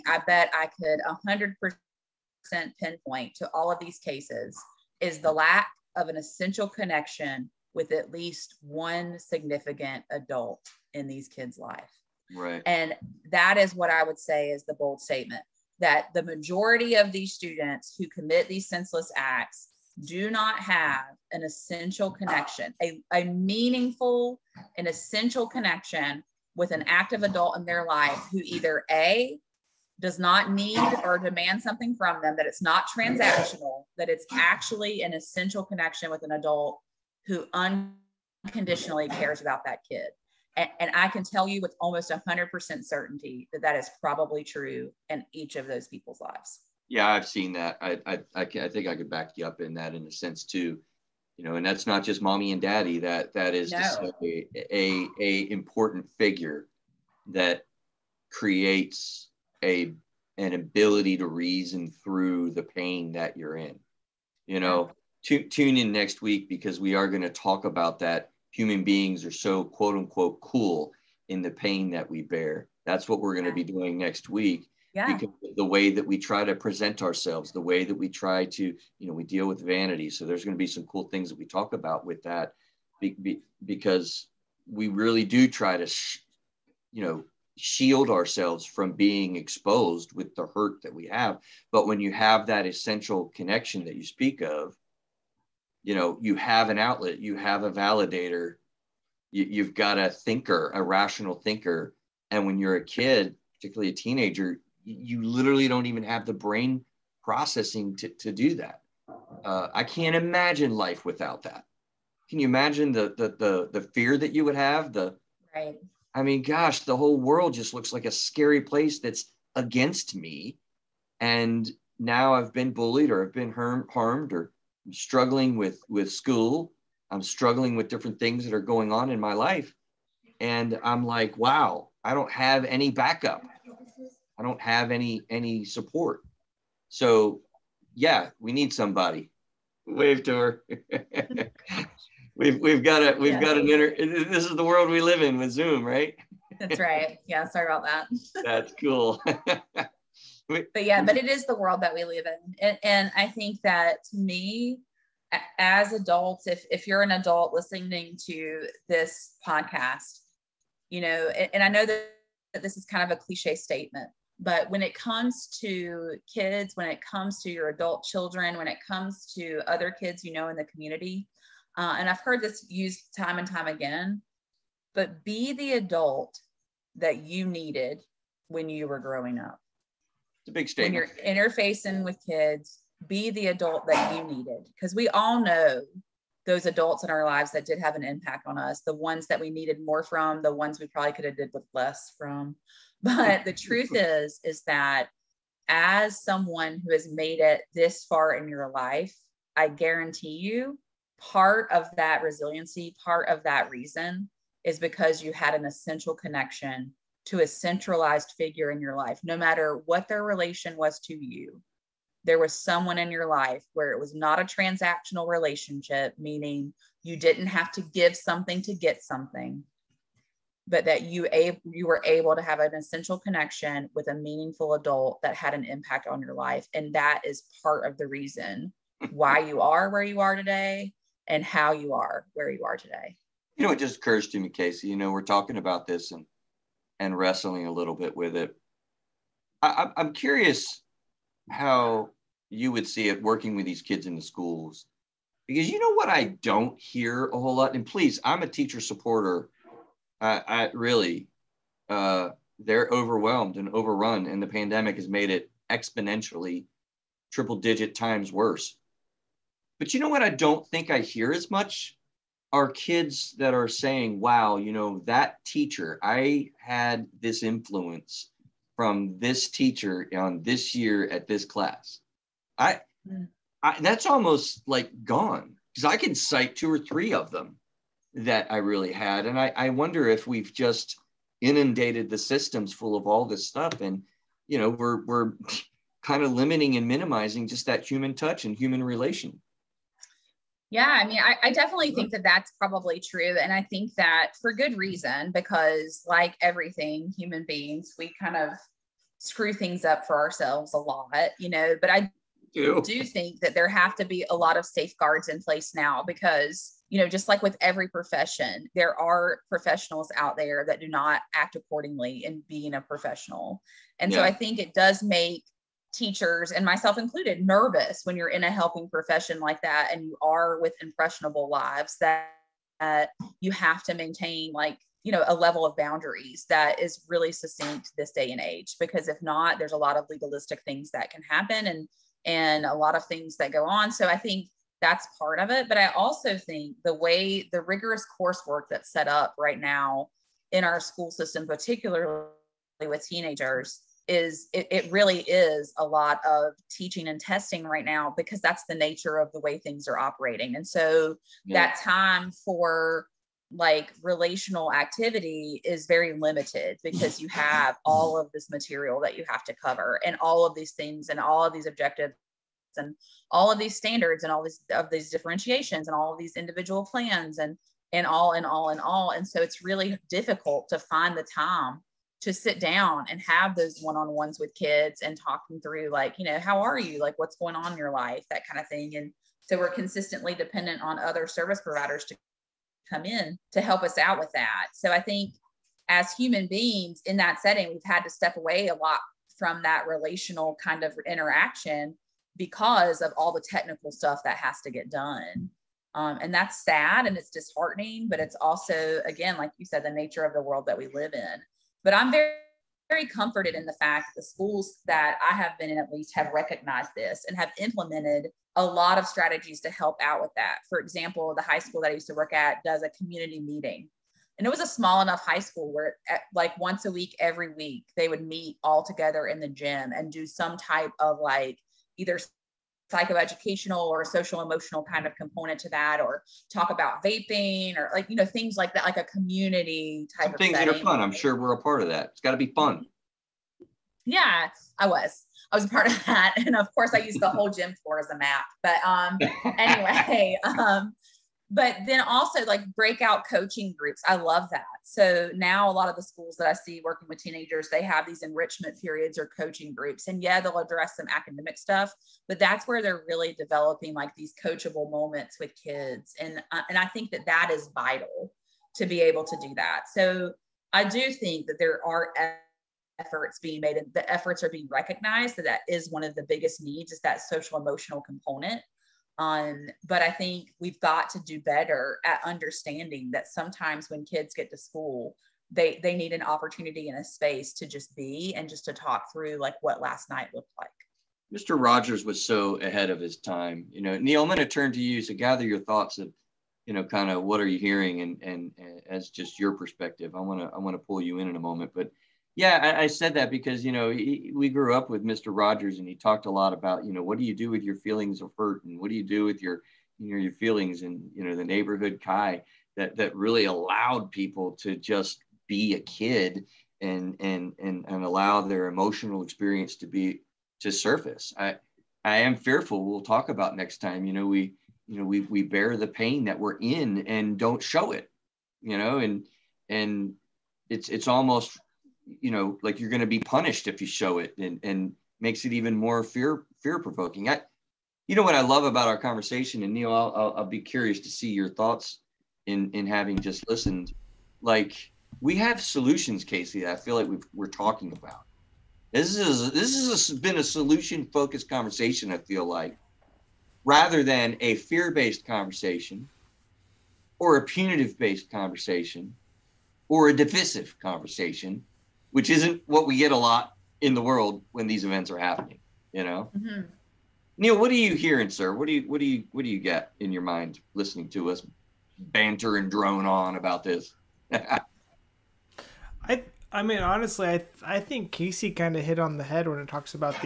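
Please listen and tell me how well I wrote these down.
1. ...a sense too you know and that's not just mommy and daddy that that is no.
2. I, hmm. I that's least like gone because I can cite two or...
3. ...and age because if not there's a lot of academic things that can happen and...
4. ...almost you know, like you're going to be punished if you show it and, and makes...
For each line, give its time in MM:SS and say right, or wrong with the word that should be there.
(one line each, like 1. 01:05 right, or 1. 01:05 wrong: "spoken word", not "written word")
1. 00:50 right
2. 04:32 wrong: "almost", not "least"
3. 05:28 wrong: "legalistic", not "academic"
4. 08:41 right.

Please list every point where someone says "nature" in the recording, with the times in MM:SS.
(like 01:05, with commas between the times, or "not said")
05:48, 06:39.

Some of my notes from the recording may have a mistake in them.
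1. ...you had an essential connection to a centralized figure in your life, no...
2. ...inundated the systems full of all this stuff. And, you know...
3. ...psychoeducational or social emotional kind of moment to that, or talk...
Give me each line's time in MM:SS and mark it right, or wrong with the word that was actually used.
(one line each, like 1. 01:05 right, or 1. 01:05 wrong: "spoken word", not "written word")
1. 03:25 right
2. 04:41 right
3. 07:02 wrong: "component", not "moment".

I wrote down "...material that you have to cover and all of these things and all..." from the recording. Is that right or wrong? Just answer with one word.
right.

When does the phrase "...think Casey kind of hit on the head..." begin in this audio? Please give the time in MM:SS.
09:27.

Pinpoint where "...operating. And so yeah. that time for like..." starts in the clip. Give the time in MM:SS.
05:49.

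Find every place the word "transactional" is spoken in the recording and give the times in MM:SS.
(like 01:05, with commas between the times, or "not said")
00:32, 03:34.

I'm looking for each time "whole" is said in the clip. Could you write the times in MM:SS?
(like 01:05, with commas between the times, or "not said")
01:56, 04:07, 07:17.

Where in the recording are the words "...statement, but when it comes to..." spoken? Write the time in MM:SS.
02:43.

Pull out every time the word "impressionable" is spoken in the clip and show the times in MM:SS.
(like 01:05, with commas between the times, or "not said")
05:20.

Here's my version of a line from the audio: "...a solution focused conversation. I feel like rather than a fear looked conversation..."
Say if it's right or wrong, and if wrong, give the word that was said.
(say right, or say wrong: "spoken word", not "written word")
wrong: "based", not "looked".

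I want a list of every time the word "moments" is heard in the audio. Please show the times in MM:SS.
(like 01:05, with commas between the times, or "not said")
07:34, 08:11.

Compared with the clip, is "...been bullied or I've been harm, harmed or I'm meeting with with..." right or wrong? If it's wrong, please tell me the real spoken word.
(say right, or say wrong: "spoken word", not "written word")
wrong: "struggling", not "meeting".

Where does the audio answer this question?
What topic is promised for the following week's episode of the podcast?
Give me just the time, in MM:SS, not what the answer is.
01:19.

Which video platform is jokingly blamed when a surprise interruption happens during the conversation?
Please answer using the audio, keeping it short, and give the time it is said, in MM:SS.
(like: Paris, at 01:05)
Zoom, at 02:25.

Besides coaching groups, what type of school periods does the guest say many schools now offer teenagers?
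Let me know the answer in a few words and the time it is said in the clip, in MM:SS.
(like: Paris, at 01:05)
enrichment periods, at 07:28.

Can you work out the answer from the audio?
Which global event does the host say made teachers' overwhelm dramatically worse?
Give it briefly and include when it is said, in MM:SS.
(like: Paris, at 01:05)
the pandemic, at 04:14.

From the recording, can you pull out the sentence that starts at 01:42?
And when you're a kid, particularly a teenager, you literally don't even have the brain processing to, to do that.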